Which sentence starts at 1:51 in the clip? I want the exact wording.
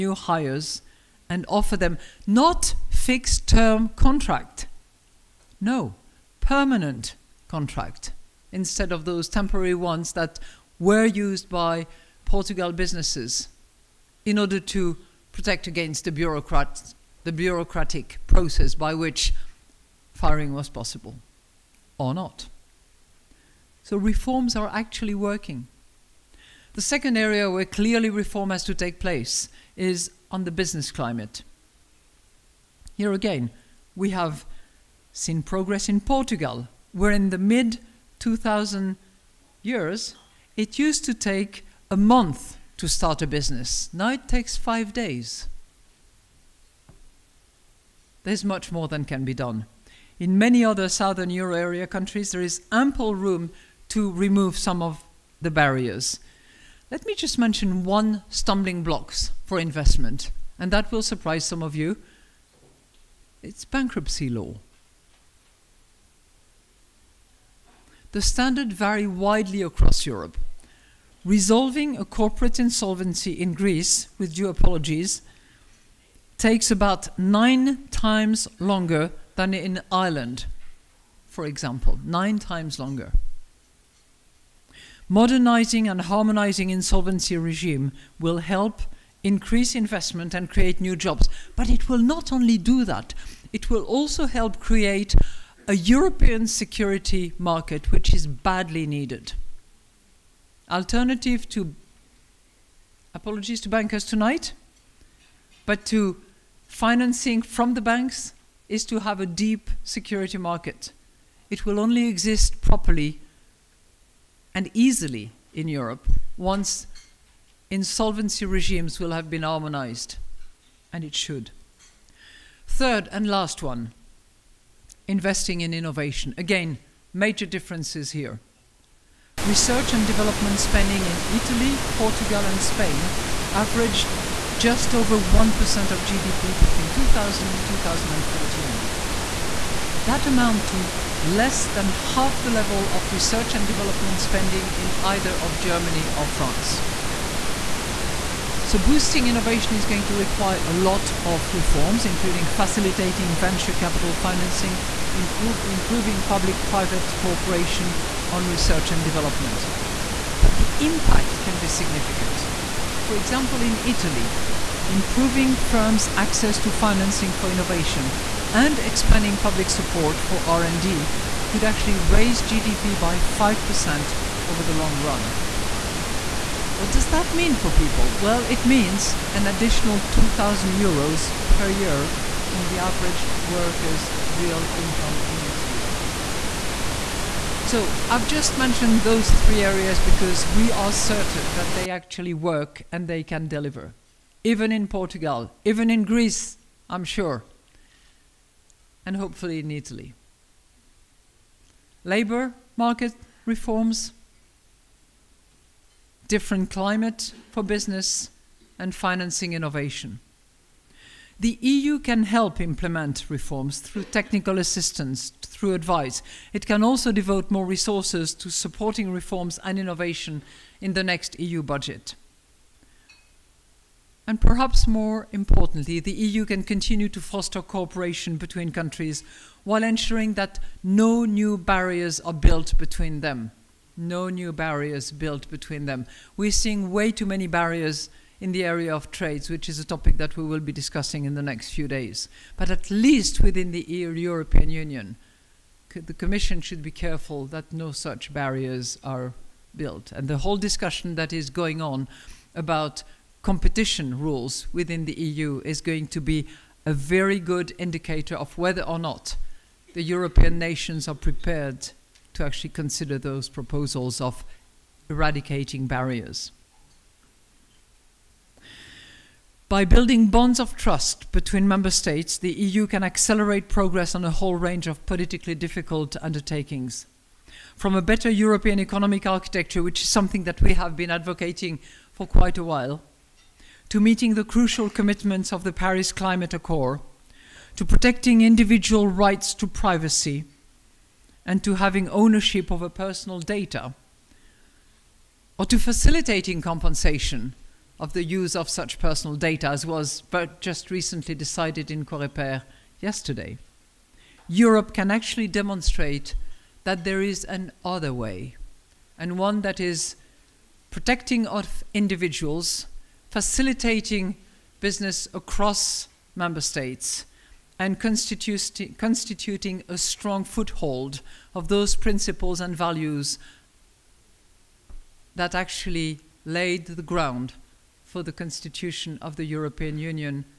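It will only exist properly and easily in Europe once insolvency regimes will have been harmonized, and it should.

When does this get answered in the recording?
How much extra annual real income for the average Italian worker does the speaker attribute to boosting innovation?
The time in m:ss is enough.
2:59.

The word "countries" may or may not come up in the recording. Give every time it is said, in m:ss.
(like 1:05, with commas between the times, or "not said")
0:51, 3:48.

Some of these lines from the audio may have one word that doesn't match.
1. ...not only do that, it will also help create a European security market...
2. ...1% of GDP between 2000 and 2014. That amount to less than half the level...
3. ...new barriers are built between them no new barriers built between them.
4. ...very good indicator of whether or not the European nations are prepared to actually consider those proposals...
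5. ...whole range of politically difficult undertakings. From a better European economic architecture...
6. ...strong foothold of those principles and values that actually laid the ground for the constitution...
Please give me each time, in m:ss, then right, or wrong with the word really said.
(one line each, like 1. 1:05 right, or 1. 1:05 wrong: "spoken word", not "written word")
1. 1:31 right
2. 2:15 right
3. 3:51 right
4. 4:16 right
5. 4:34 right
6. 5:19 right.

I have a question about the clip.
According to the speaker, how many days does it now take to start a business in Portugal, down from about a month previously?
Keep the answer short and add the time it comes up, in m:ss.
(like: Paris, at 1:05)
5 days, at 0:44.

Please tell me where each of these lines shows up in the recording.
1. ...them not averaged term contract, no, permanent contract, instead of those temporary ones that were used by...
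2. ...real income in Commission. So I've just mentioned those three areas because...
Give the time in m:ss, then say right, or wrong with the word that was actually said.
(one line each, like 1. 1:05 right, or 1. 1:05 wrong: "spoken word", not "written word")
1. 0:01 wrong: "fixed", not "averaged"
2. 3:04 wrong: "Italy", not "Commission".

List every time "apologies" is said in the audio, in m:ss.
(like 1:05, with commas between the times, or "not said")
1:14, 1:43.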